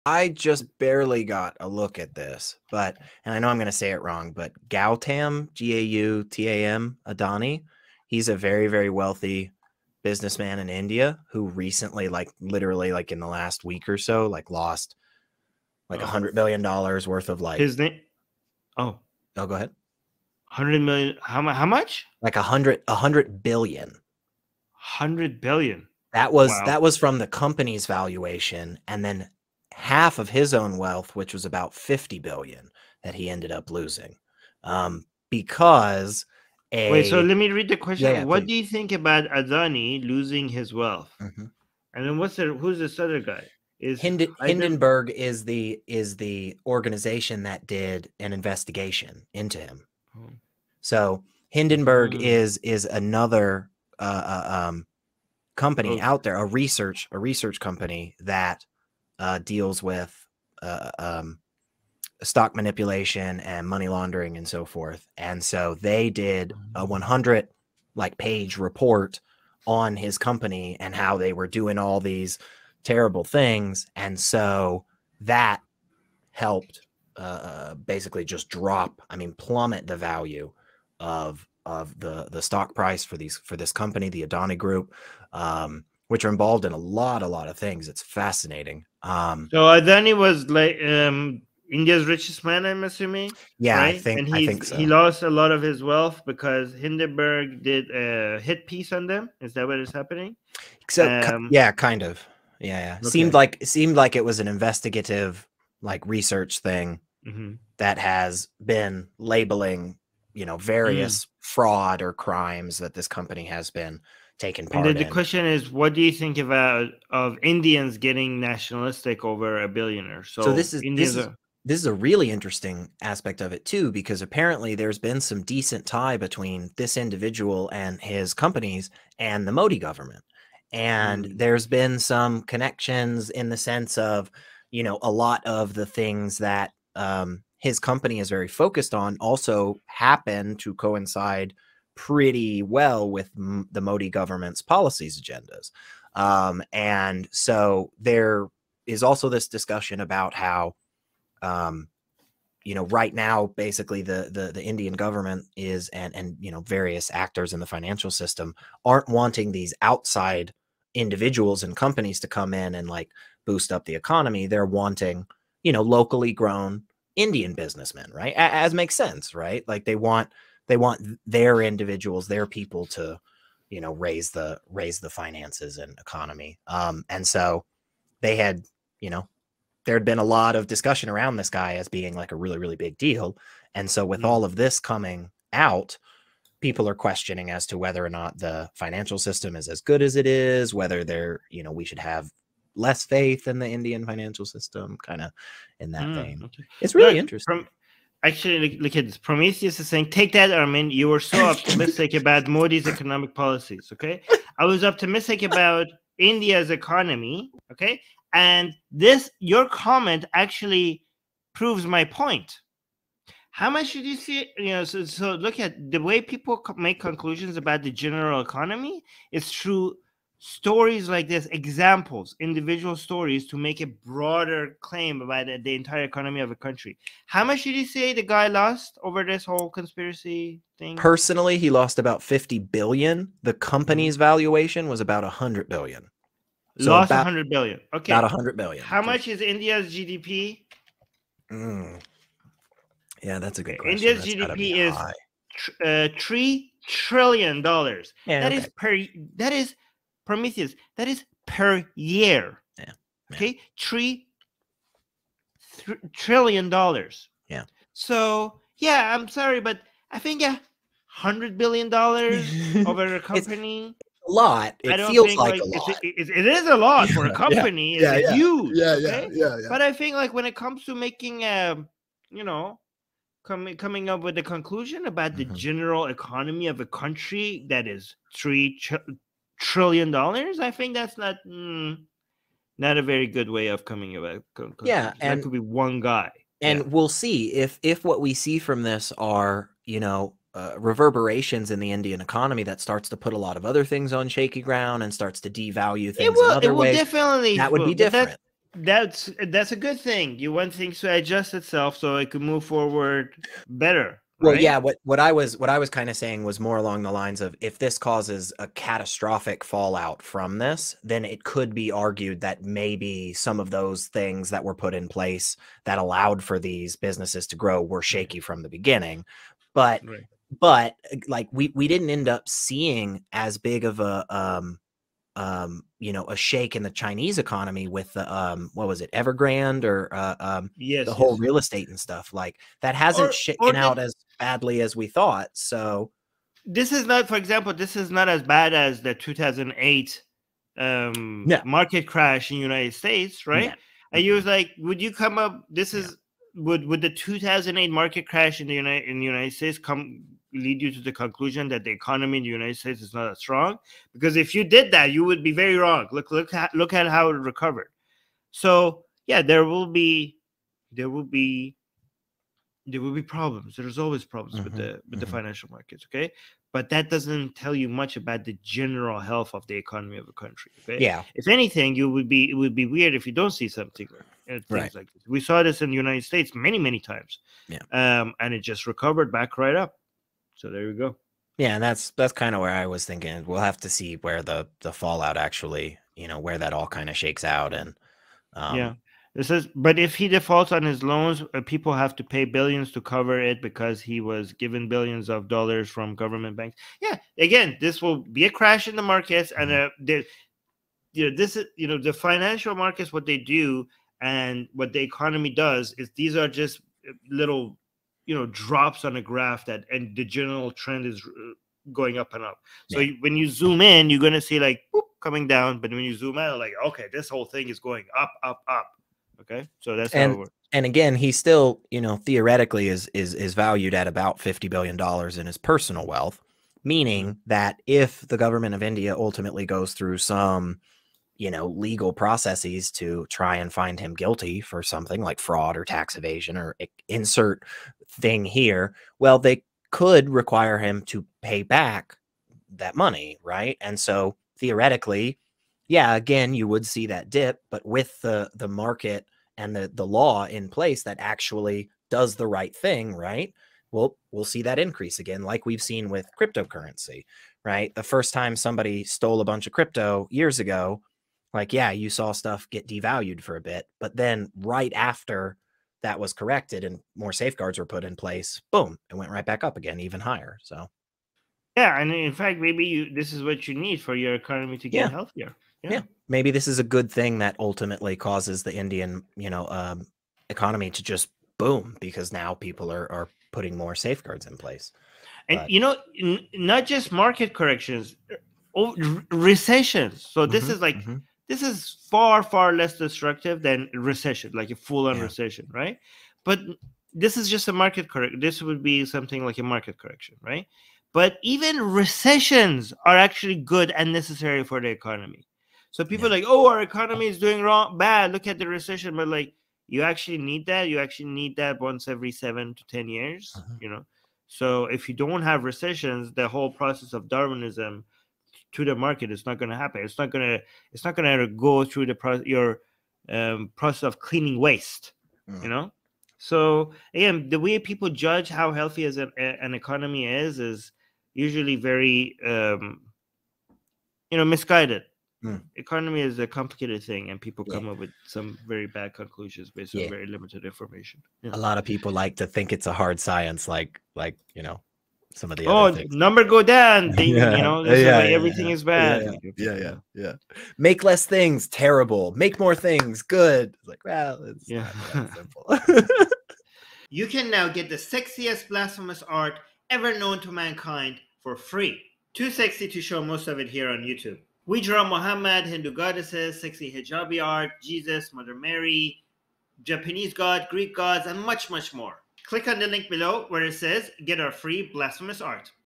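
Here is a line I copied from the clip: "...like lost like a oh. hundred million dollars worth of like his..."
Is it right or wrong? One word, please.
right.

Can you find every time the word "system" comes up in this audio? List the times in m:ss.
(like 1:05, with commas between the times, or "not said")
2:38, 3:09, 3:14.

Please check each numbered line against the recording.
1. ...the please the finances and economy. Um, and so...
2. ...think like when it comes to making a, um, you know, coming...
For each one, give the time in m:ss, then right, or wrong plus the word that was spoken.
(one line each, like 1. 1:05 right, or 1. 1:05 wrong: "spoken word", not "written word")
1. 2:54 wrong: "raise", not "please"
2. 4:29 right.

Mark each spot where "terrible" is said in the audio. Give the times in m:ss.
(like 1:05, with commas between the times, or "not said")
1:12, 9:11.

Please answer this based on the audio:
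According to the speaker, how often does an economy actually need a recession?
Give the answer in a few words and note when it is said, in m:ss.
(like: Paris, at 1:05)
every seven to ten years, at 8:31.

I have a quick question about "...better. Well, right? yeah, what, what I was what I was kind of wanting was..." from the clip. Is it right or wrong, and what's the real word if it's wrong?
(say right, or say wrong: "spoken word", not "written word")
wrong: "saying", not "wanting".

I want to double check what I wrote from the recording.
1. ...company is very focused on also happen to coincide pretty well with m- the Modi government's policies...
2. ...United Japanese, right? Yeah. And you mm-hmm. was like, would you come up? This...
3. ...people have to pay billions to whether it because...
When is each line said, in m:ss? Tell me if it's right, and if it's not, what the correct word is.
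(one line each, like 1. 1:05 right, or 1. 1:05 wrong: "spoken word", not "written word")
1. 2:17 right
2. 5:42 wrong: "States", not "Japanese"
3. 6:31 wrong: "cover", not "whether".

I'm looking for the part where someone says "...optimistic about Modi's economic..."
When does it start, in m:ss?
3:21.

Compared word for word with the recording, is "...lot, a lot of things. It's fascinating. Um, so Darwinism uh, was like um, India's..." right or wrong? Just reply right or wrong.
wrong.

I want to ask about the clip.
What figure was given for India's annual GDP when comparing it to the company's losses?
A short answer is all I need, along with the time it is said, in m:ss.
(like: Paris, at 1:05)
3 trillion dollars, at 4:06.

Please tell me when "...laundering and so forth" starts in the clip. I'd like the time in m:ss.
1:03.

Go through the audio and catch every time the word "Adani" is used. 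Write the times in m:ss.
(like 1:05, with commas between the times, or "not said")
0:07, 0:39, 1:24, 1:29.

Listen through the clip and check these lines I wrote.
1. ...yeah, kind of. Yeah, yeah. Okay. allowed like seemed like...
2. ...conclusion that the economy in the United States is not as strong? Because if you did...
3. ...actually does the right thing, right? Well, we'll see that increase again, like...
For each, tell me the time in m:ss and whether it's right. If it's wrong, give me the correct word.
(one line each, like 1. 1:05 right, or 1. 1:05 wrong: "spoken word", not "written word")
1. 1:41 wrong: "seemed", not "allowed"
2. 5:51 right
3. 7:31 right.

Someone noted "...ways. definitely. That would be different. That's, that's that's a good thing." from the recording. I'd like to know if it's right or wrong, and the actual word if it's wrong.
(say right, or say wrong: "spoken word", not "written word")
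right.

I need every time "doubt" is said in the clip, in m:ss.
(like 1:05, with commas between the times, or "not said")
not said.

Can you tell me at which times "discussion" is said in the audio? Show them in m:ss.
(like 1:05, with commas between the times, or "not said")
2:29, 3:00.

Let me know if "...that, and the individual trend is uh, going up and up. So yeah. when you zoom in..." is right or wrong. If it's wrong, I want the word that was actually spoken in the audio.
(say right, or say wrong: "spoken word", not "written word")
wrong: "general", not "individual".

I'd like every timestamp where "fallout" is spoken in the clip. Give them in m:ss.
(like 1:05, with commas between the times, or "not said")
5:09, 6:24.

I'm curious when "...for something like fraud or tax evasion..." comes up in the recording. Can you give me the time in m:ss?
7:14.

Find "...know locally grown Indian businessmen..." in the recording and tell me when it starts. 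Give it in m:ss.
2:45.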